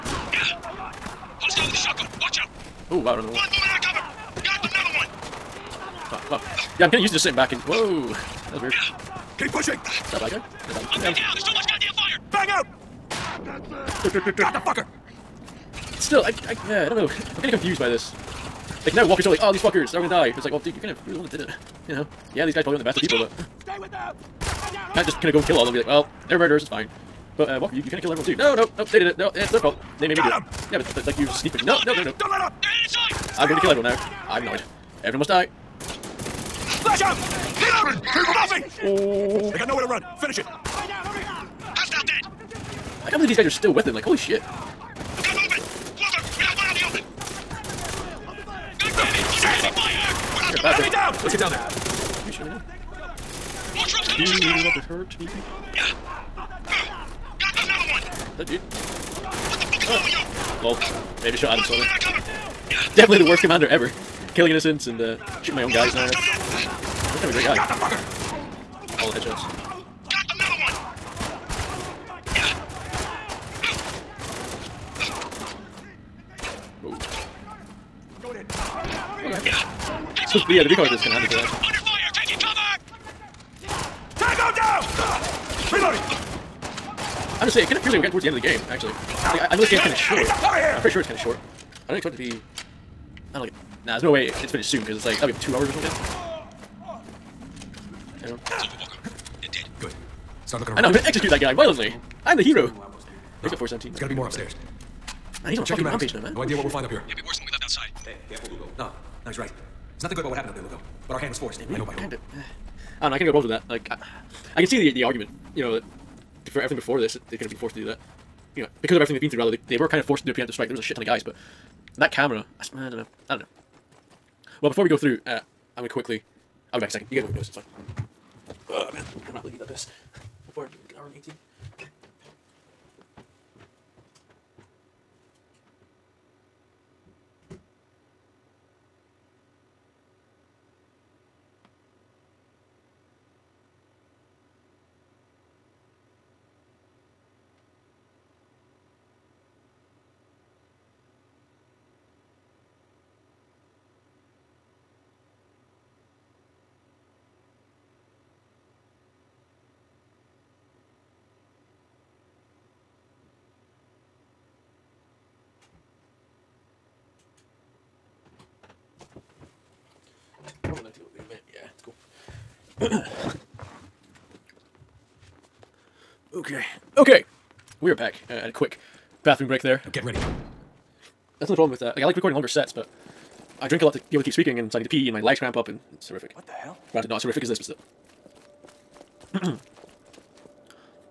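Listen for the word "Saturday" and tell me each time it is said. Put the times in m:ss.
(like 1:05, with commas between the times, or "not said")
not said.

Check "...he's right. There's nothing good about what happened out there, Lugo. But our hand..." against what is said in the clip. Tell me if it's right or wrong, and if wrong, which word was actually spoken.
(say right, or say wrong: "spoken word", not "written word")
right.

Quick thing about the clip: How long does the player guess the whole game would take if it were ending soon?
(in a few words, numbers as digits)
2 hours.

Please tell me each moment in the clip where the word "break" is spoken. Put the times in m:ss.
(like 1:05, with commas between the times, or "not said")
2:59.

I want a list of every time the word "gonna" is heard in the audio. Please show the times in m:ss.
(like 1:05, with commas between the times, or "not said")
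0:20, 1:40.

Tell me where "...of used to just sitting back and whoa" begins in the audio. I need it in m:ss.
0:06.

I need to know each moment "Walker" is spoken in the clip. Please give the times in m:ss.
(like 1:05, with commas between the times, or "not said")
0:19, 0:27.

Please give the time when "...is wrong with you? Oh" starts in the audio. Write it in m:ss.
0:59.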